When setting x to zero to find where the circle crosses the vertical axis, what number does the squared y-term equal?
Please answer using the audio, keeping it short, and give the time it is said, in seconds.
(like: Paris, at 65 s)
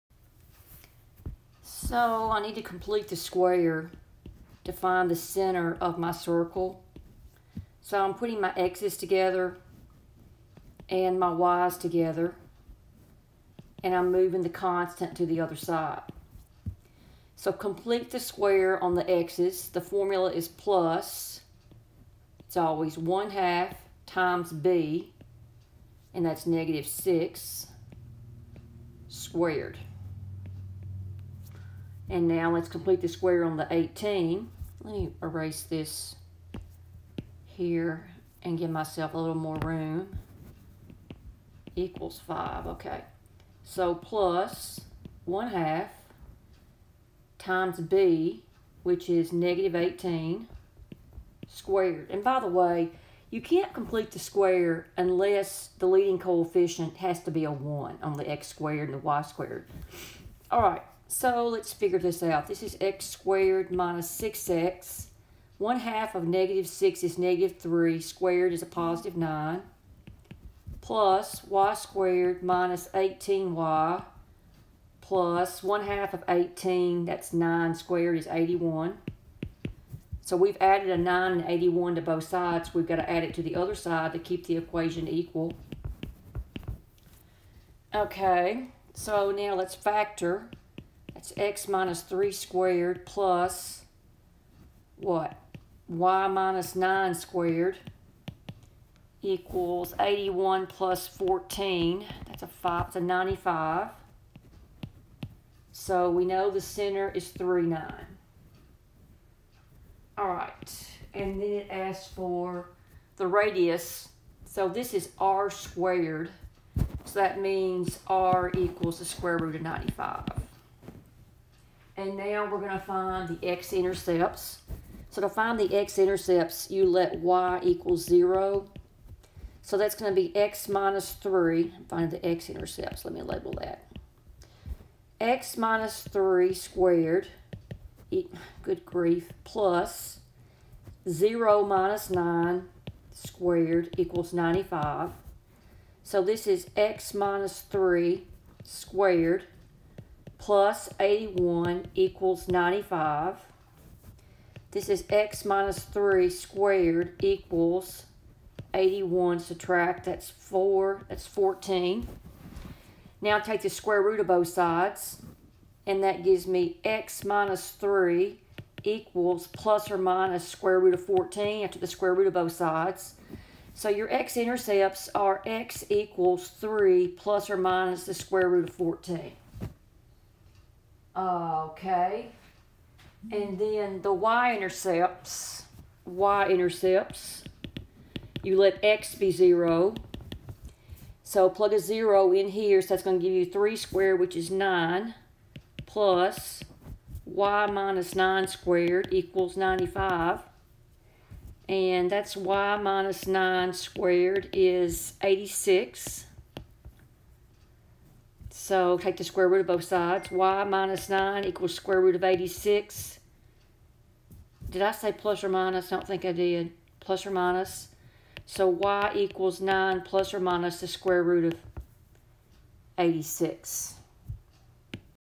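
86, at 202 s.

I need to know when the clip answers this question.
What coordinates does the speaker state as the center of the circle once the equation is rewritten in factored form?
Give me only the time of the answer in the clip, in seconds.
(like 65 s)
107 s.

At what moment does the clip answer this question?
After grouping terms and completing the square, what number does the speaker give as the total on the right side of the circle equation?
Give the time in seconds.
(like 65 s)
102 s.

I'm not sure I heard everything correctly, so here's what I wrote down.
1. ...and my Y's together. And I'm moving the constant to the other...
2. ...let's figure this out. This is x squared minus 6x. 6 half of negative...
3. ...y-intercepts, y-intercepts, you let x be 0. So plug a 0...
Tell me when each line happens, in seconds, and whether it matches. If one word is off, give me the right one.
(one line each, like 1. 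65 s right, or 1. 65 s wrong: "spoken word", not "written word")
1. 10 s right
2. 61 s wrong: "1", not "6"
3. 184 s right.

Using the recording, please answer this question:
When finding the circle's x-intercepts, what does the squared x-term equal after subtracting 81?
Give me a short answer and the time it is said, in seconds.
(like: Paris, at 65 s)
14, at 161 s.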